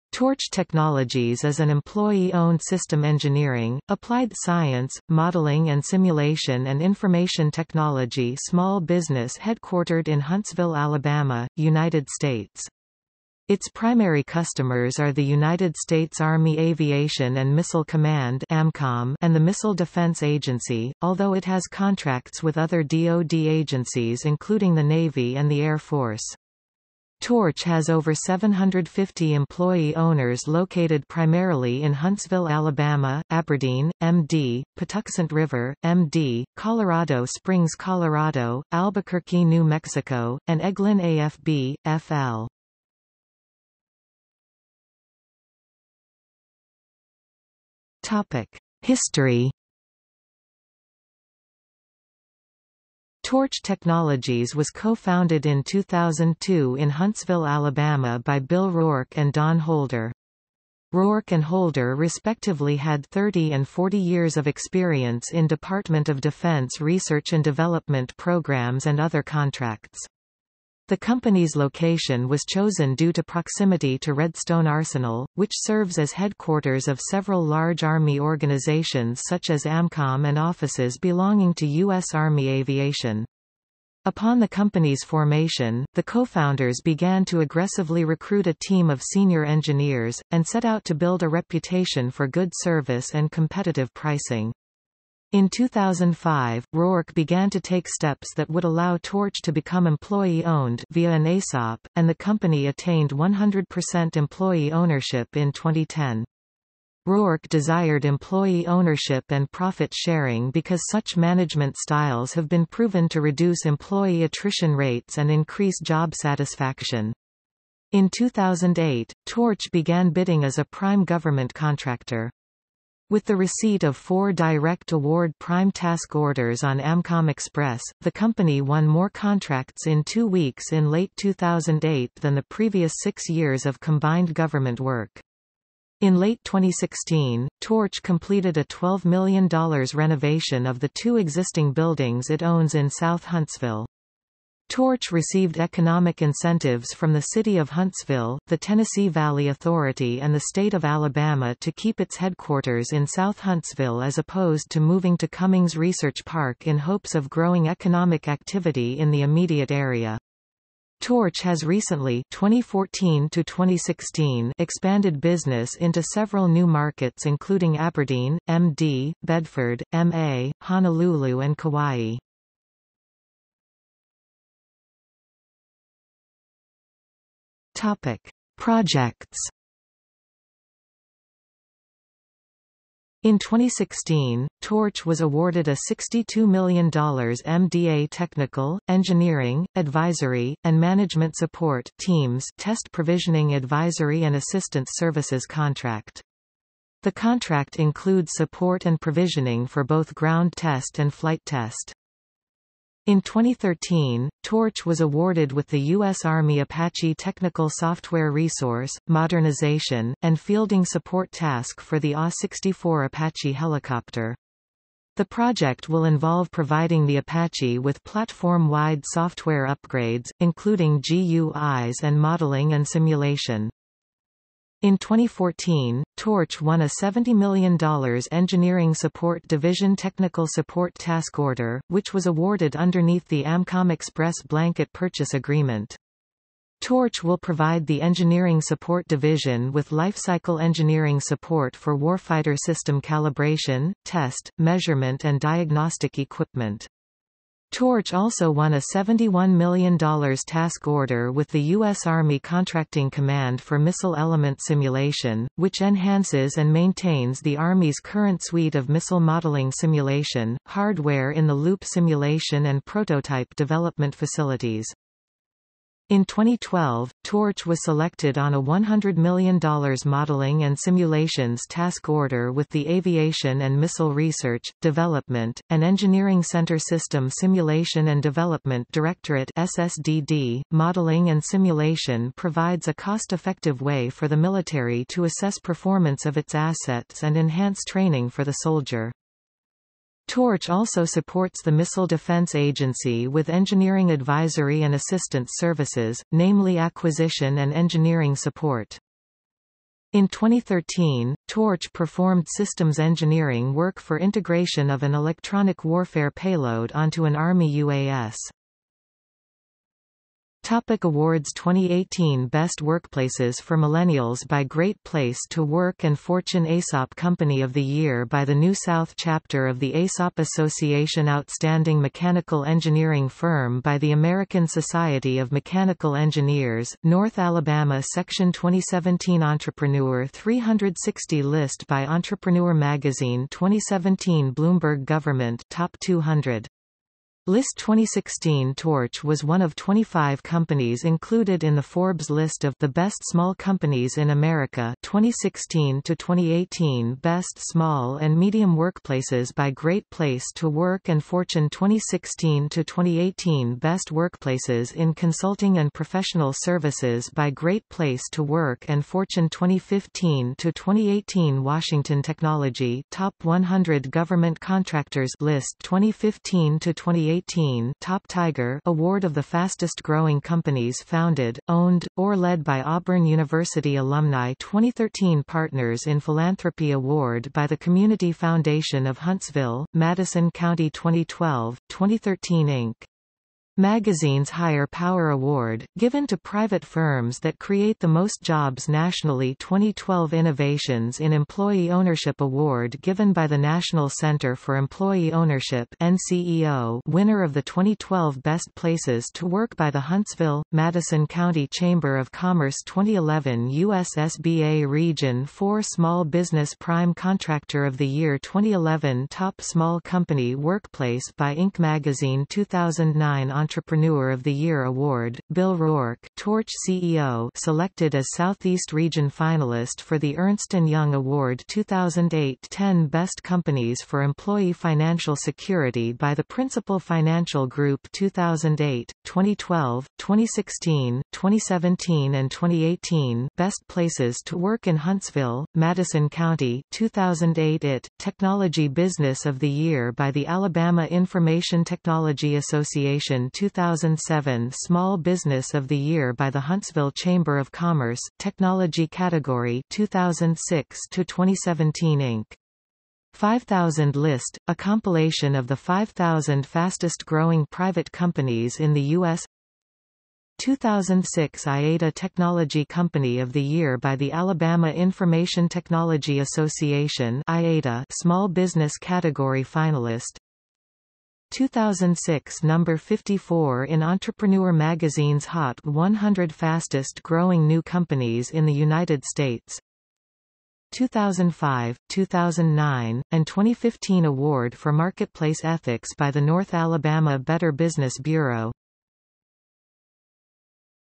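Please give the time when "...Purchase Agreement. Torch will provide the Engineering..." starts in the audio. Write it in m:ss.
3:54.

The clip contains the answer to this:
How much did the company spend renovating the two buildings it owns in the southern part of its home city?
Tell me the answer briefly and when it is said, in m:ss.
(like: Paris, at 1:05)
$12 million, at 2:18.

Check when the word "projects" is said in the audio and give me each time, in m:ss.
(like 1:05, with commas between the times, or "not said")
2:58, 3:35.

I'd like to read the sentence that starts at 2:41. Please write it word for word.
Torch has recently 2014 to 2016 expanded business into several new markets including Aberdeen, MD, Bedford, MA, Honolulu and Kauai.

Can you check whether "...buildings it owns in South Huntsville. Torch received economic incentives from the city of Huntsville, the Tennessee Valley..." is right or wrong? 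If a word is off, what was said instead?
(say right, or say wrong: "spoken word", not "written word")
right.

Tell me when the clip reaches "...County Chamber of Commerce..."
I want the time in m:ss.
6:41.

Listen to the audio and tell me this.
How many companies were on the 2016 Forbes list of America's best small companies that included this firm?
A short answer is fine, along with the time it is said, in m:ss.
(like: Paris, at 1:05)
25, at 5:39.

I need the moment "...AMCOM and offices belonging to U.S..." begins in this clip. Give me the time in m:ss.
1:19.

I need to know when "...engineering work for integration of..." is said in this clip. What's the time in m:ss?
5:02.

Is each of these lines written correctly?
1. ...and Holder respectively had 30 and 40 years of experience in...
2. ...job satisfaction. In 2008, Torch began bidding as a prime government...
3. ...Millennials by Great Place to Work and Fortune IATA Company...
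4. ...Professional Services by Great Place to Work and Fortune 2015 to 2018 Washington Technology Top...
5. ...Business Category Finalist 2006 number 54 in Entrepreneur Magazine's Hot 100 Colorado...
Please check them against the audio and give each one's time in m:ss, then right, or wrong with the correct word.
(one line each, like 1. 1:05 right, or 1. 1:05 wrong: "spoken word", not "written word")
1. 1:01 right
2. 1:55 right
3. 5:13 wrong: "ESOP", not "IATA"
4. 5:55 right
5. 7:48 wrong: "Fastest", not "Colorado".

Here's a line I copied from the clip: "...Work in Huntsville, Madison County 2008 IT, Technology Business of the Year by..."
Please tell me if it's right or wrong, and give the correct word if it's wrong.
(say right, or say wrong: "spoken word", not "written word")
right.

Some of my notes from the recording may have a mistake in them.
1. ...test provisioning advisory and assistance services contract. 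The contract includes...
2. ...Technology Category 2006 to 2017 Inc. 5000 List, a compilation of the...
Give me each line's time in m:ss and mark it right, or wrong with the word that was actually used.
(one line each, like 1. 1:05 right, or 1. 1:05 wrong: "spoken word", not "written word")
1. 3:12 right
2. 7:28 right.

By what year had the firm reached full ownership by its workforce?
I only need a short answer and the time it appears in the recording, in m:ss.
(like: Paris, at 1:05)
2010, at 1:45.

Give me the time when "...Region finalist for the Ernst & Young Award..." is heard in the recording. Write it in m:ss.
6:58.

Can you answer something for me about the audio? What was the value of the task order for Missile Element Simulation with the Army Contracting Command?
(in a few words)
$71 million.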